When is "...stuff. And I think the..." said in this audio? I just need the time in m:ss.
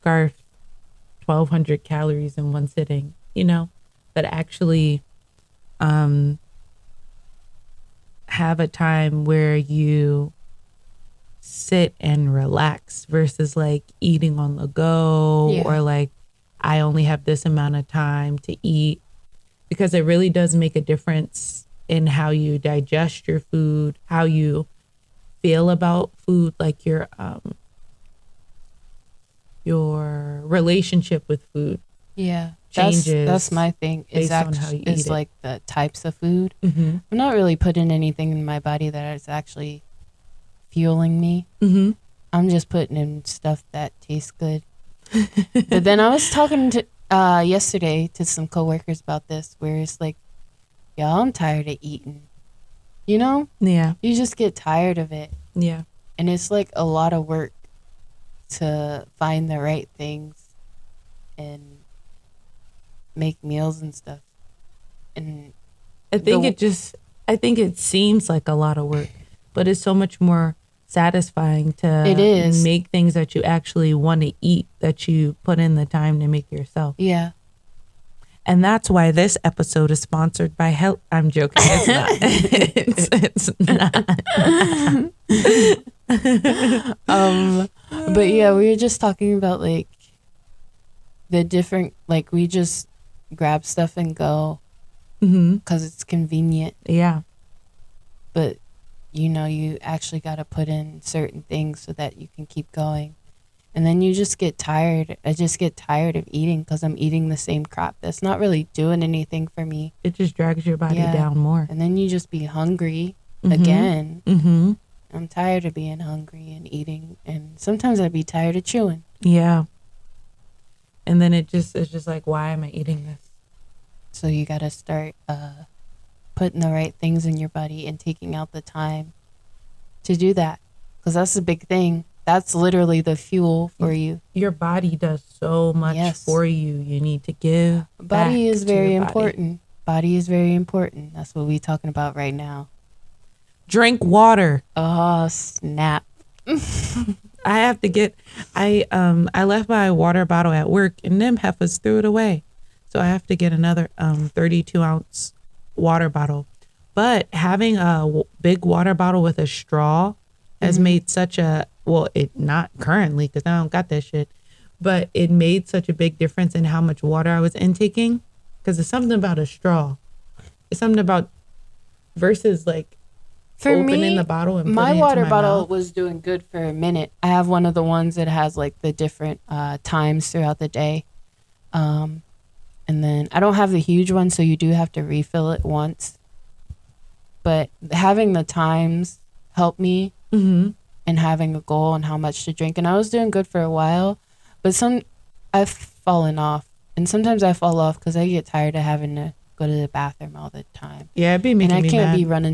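1:03.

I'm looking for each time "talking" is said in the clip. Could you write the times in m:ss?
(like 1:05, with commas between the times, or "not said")
0:46, 1:29, 2:21.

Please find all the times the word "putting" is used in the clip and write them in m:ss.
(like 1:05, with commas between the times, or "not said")
0:37, 0:42, 2:06.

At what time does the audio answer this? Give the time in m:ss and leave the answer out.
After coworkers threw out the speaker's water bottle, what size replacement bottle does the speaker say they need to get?
2:34.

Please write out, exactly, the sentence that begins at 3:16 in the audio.
And sometimes I fall off because I get tired of having to go to the bathroom all the time.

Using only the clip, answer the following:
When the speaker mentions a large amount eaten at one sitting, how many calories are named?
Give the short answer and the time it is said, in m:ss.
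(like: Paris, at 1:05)
1200, at 0:01.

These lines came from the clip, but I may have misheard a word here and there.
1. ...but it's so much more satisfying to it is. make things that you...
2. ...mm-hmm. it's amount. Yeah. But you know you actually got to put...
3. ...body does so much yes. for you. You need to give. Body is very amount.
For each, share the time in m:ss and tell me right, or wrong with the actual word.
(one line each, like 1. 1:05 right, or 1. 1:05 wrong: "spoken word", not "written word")
1. 1:09 right
2. 1:35 wrong: "convenient", not "amount"
3. 2:14 wrong: "important", not "amount".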